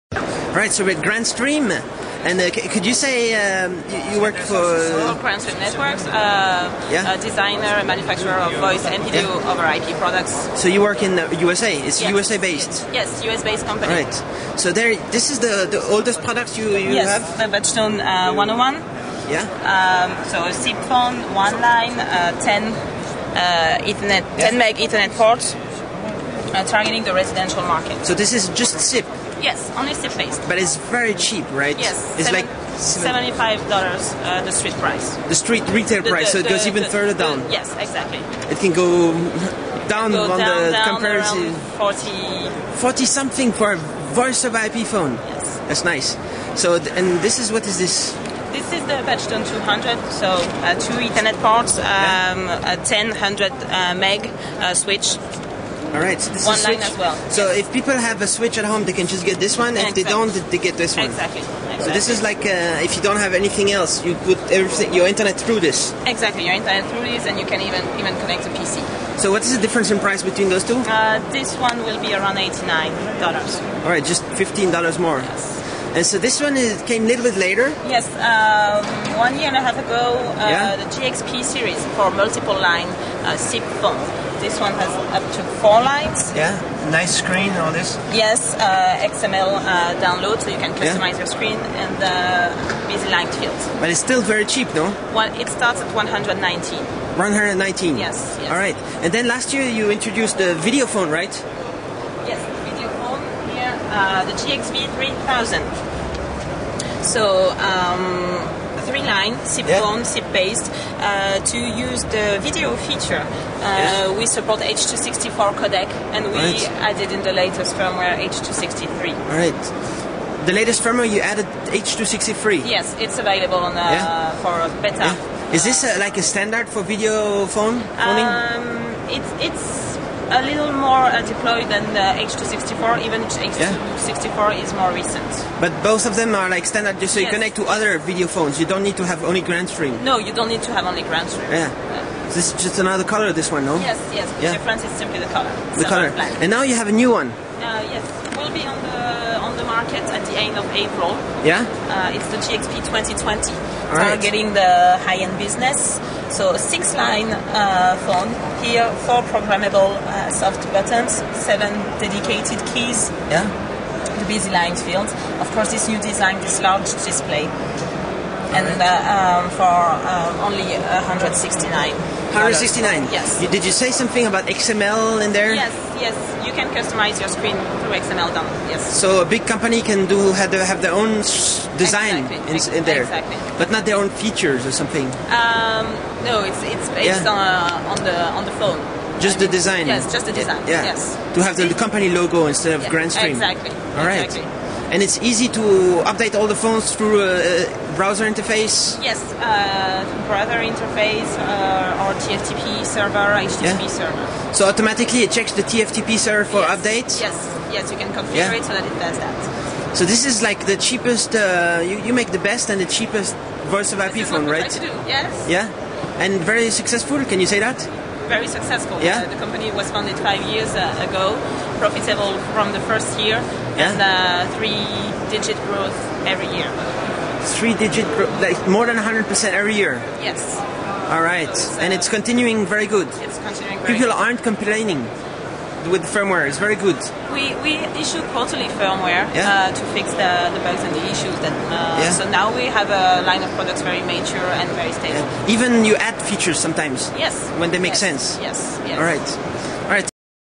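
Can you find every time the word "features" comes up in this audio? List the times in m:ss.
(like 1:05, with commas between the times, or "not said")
1:52, 3:04, 4:06.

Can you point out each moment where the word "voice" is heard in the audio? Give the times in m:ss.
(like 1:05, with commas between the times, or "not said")
0:08, 0:44, 3:33.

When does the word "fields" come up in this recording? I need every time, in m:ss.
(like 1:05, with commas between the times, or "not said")
1:33, 2:44.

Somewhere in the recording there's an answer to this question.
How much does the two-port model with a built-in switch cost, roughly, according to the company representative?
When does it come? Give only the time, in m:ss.
1:12.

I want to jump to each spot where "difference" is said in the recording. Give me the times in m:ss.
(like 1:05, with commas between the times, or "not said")
1:09, 2:24.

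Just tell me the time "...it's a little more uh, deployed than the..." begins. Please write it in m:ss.
2:09.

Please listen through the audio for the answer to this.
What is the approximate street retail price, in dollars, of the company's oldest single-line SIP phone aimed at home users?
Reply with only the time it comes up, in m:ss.
0:32.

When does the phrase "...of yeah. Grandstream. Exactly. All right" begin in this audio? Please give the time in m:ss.
3:12.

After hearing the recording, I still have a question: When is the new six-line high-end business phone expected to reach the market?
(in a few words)
End of April.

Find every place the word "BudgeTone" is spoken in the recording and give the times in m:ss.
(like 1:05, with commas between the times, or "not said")
0:17, 0:49.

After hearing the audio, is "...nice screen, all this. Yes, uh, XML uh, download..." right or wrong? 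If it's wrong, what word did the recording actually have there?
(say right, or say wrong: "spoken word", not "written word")
right.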